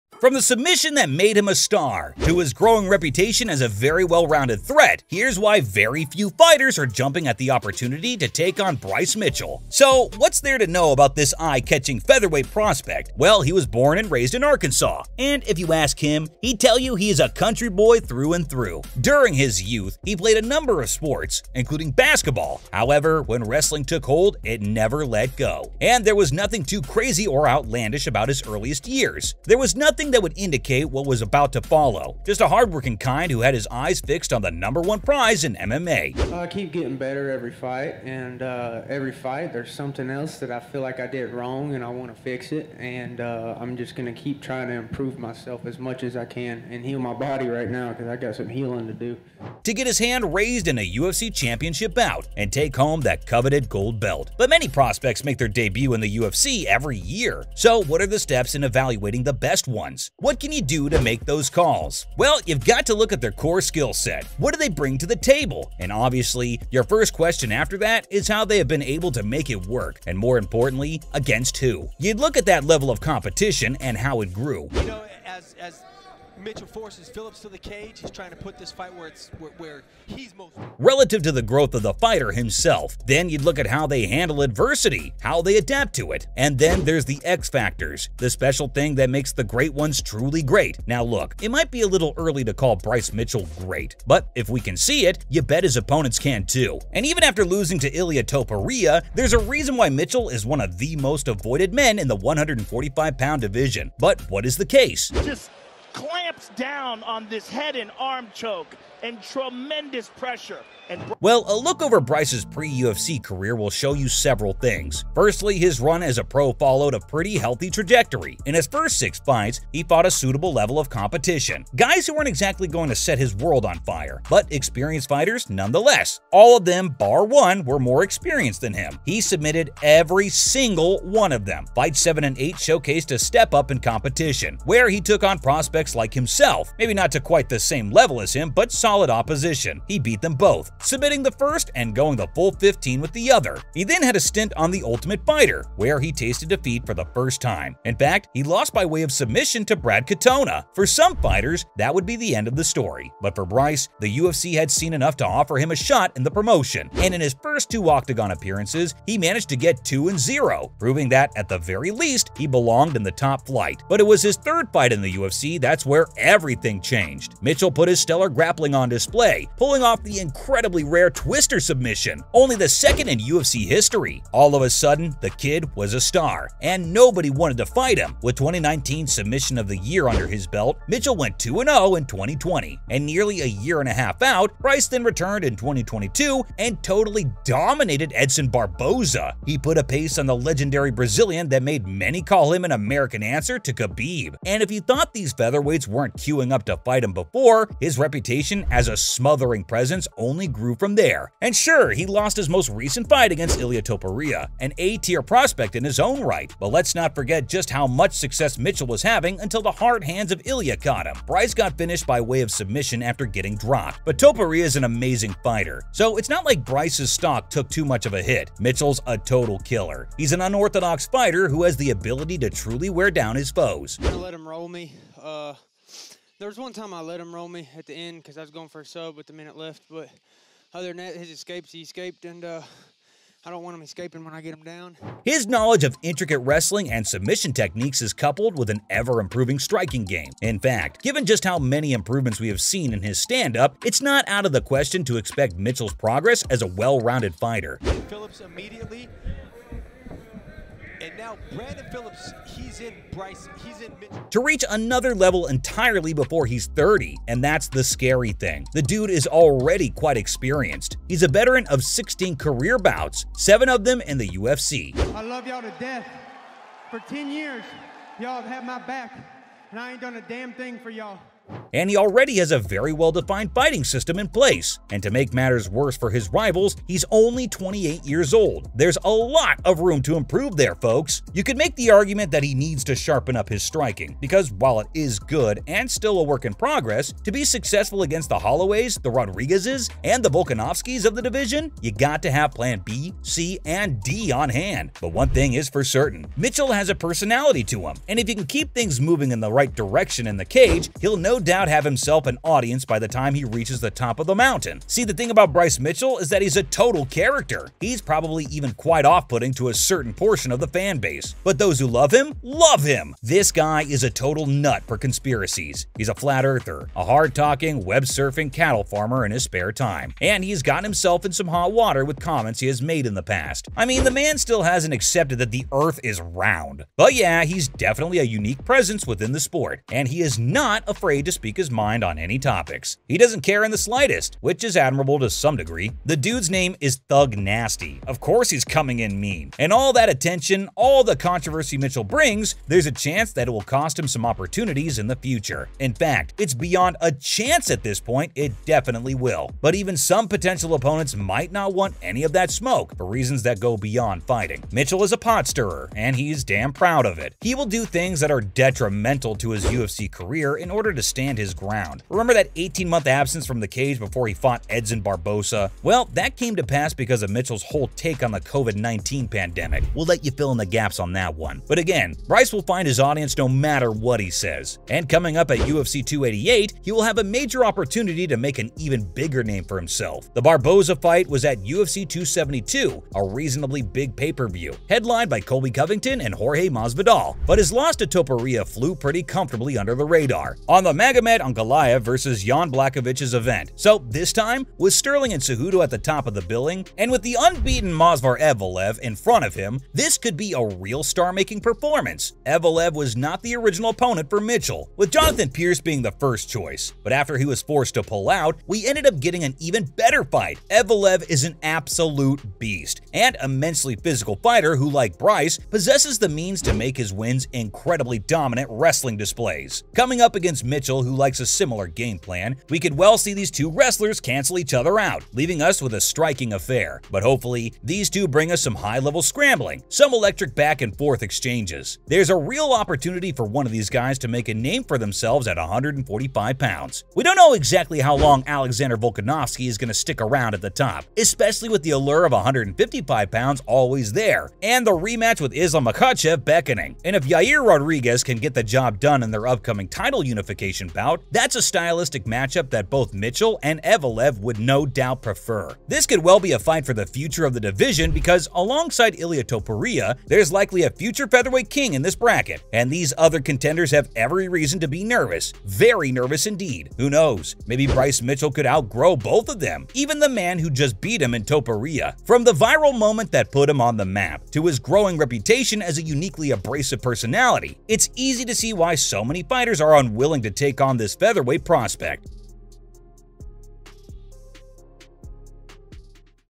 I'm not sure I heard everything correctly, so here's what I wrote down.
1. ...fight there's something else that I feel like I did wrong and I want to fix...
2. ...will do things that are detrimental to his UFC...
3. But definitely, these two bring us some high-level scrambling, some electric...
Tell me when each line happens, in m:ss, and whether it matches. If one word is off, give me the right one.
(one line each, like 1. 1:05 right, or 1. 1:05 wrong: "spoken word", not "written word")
1. 0:39 right
2. 5:57 right
3. 7:07 wrong: "hopefully", not "definitely".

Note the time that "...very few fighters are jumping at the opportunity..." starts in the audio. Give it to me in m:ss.
0:05.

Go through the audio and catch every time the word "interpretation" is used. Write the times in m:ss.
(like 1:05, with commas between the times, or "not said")
not said.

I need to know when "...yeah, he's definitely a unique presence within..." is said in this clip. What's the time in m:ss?
5:27.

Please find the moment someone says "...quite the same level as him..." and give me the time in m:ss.
2:17.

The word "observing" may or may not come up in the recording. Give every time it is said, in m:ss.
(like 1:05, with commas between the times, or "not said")
not said.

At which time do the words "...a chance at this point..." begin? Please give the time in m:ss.
5:47.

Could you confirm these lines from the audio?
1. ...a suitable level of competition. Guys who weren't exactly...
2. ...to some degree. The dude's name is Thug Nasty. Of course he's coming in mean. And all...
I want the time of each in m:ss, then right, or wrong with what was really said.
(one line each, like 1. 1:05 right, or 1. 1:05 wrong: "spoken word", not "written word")
1. 2:00 right
2. 5:35 right.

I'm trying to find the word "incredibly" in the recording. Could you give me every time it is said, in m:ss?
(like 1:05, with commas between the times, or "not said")
2:50, 6:57.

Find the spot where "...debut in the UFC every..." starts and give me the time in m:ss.
0:55.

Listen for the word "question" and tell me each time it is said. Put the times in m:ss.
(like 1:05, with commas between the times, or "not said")
1:07, 4:04.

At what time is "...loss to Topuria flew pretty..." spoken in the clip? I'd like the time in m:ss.
6:27.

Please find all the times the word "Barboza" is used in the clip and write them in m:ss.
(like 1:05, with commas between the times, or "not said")
3:08, 6:05, 6:20.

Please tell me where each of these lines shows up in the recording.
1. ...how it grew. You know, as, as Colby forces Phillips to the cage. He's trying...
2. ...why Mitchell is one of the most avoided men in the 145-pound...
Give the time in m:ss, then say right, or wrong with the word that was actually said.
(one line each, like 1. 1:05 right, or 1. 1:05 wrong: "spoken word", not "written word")
1. 1:13 wrong: "Mitchell", not "Colby"
2. 1:39 right.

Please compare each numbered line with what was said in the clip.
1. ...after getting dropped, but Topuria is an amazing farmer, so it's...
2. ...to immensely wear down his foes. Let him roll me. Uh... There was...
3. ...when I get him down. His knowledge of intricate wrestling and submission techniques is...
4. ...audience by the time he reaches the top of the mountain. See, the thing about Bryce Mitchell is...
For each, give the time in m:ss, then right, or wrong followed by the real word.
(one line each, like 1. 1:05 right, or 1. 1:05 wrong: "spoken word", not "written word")
1. 3:33 wrong: "fighter", not "farmer"
2. 3:42 wrong: "truly", not "immensely"
3. 3:54 right
4. 5:02 right.